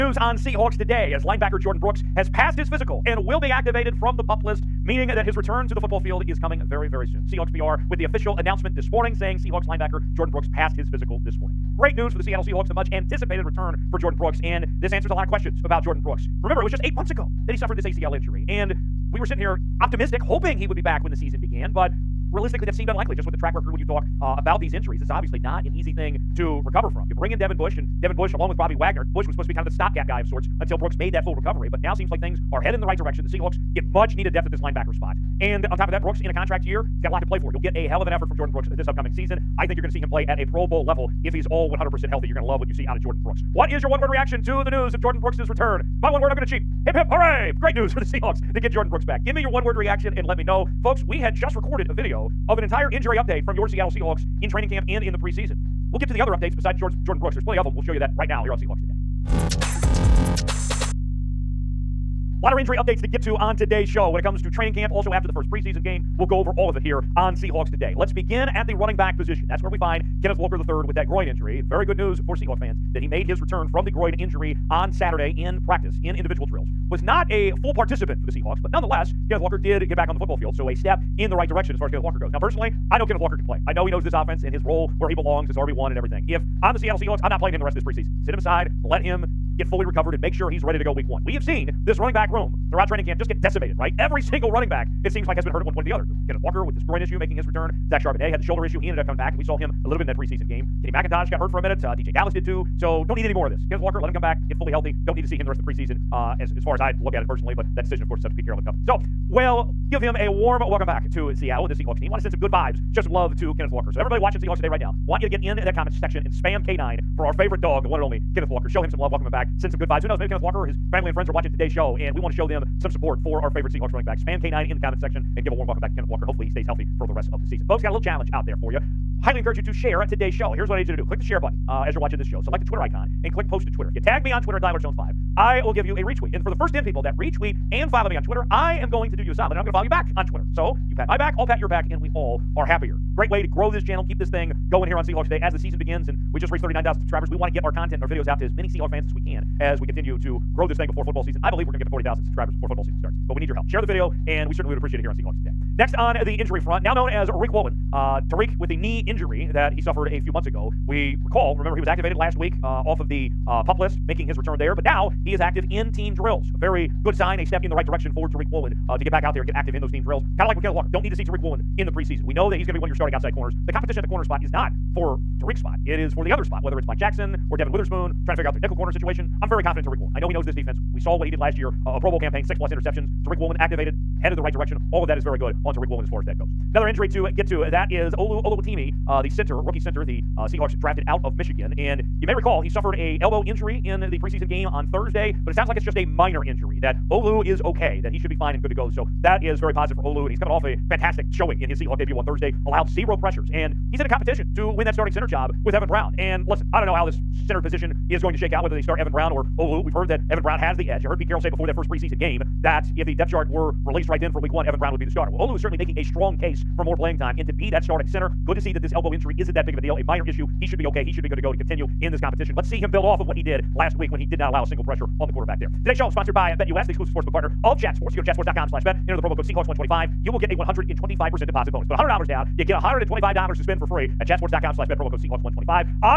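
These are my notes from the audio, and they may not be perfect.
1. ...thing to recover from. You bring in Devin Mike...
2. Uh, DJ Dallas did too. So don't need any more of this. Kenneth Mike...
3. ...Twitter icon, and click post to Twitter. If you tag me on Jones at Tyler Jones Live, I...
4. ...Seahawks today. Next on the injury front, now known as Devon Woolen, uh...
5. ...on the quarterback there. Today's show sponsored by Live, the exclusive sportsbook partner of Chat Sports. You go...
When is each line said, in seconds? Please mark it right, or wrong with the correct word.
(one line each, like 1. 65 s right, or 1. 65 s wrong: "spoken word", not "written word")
1. 25 s wrong: "Bush", not "Mike"
2. 101 s wrong: "Walker", not "Mike"
3. 132 s wrong: "Twitter", not "Jones"
4. 155 s wrong: "Riq", not "Devon"
5. 225 s wrong: "BetUS", not "Live".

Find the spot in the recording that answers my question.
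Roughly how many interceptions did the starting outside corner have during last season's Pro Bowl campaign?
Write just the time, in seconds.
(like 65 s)
182 s.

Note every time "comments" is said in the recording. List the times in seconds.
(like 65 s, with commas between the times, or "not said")
115 s, 124 s.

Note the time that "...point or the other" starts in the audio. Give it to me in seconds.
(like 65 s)
95 s.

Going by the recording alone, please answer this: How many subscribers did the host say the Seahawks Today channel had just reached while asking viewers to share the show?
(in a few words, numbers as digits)
39,000.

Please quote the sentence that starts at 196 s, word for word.
That Olu is okay, that he should be fine and good to go.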